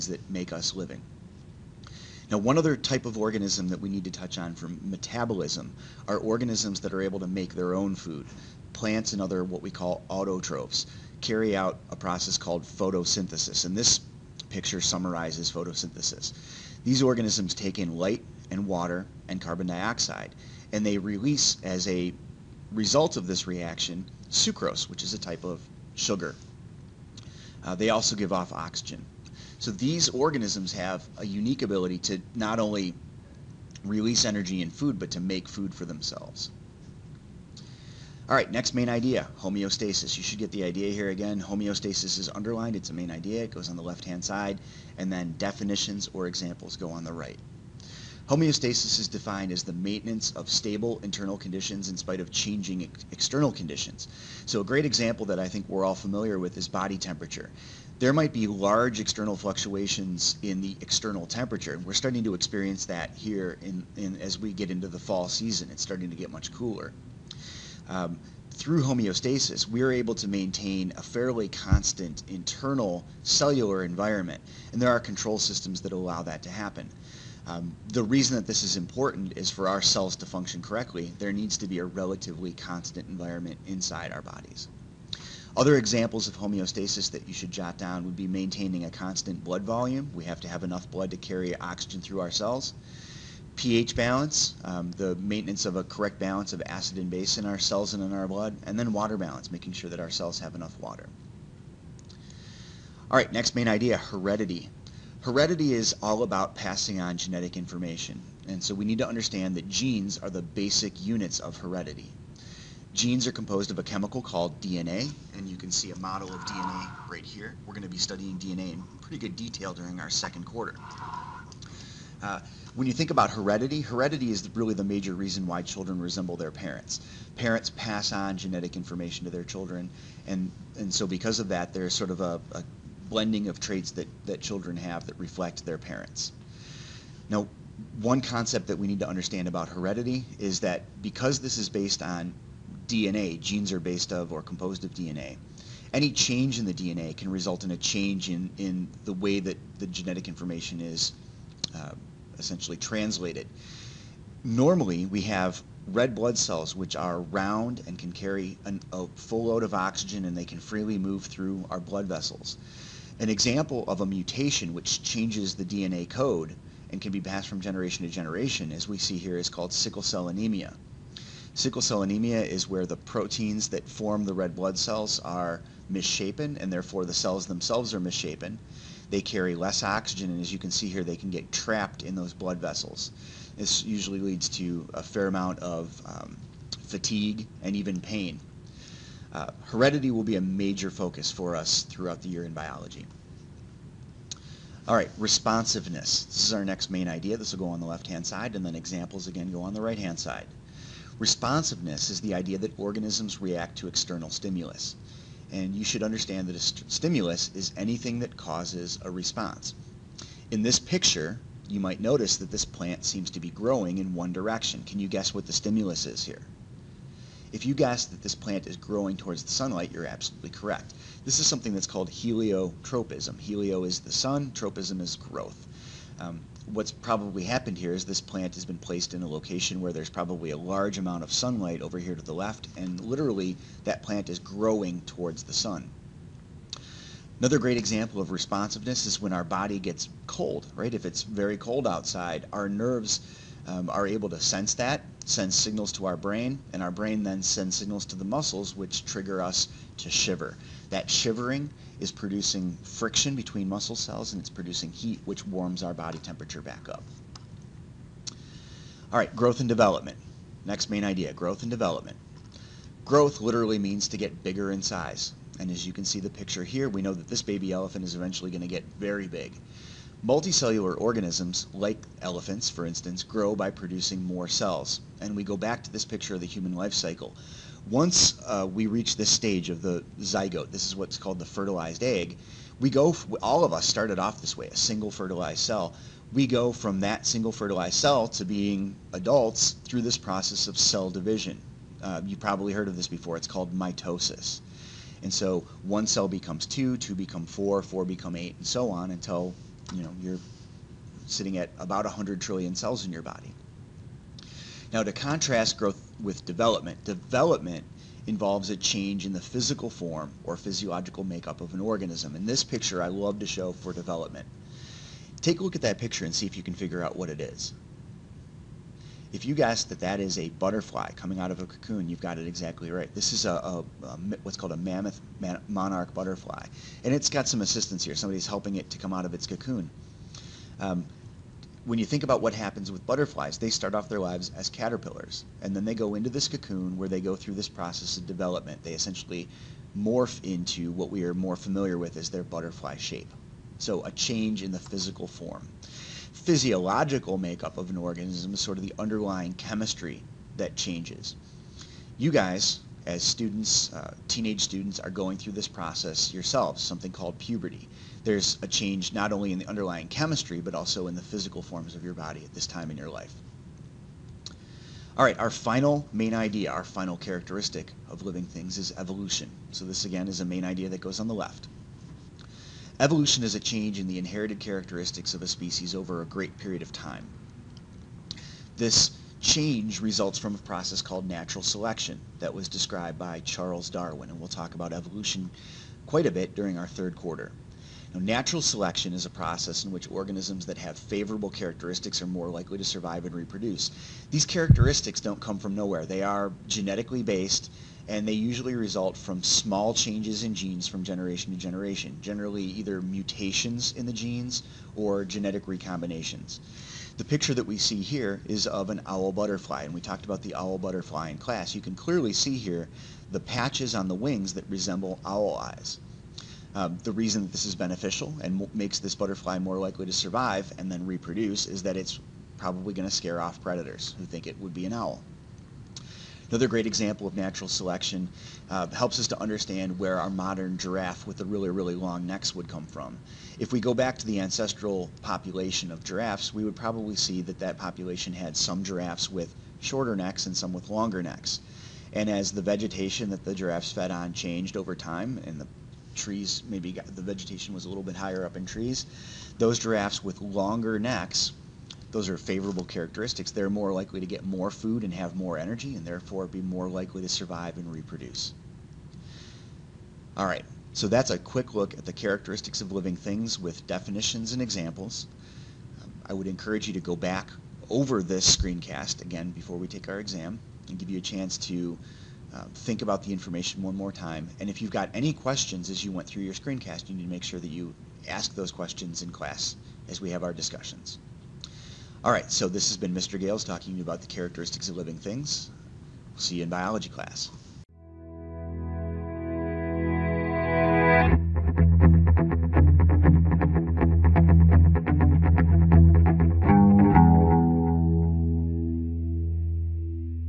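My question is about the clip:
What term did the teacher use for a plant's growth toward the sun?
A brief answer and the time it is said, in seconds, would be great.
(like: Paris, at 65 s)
heliotropism, at 222 s.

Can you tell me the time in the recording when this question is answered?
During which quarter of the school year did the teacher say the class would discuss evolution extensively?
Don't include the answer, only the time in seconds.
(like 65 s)
386 s.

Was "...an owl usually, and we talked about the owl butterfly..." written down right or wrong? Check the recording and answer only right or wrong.
wrong.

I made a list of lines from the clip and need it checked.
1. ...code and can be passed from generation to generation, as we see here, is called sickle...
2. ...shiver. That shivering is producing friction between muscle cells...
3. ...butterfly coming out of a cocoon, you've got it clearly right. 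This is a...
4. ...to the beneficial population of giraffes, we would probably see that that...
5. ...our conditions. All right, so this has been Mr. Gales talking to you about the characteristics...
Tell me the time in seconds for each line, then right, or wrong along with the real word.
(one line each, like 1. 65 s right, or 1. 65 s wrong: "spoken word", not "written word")
1. 166 s right
2. 250 s right
3. 320 s wrong: "exactly", not "clearly"
4. 434 s wrong: "ancestral", not "beneficial"
5. 480 s wrong: "discussions", not "conditions".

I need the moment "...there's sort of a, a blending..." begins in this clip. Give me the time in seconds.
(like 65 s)
131 s.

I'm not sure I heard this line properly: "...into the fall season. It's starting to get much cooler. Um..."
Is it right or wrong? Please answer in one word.
right.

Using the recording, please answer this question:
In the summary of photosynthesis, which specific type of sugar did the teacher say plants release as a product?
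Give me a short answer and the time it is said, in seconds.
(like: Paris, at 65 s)
sucrose, at 24 s.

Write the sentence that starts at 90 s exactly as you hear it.
We have to have enough blood to carry oxygen through our cells.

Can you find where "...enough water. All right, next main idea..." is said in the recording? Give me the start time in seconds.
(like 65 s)
100 s.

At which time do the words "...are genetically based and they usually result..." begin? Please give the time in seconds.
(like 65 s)
396 s.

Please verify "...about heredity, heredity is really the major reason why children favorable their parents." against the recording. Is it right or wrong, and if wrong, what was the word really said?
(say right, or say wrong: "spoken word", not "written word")
wrong: "resemble", not "favorable".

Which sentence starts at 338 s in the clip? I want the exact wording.
They essentially morph into what we are more familiar with as their butterfly shape.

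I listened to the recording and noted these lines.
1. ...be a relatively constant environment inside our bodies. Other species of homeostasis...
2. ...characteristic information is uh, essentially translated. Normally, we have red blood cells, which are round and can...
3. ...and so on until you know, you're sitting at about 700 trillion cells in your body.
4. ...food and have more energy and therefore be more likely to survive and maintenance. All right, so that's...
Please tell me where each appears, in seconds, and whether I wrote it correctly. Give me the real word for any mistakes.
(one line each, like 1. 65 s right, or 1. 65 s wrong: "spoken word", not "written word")
1. 81 s wrong: "examples", not "species"
2. 149 s wrong: "genetic", not "characteristic"
3. 298 s wrong: "100", not "700"
4. 454 s wrong: "reproduce", not "maintenance".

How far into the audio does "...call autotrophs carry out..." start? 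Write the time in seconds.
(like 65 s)
9 s.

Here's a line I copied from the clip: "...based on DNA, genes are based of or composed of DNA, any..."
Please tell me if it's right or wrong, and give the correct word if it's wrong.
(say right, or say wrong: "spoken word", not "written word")
right.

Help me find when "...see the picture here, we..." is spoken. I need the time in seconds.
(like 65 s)
266 s.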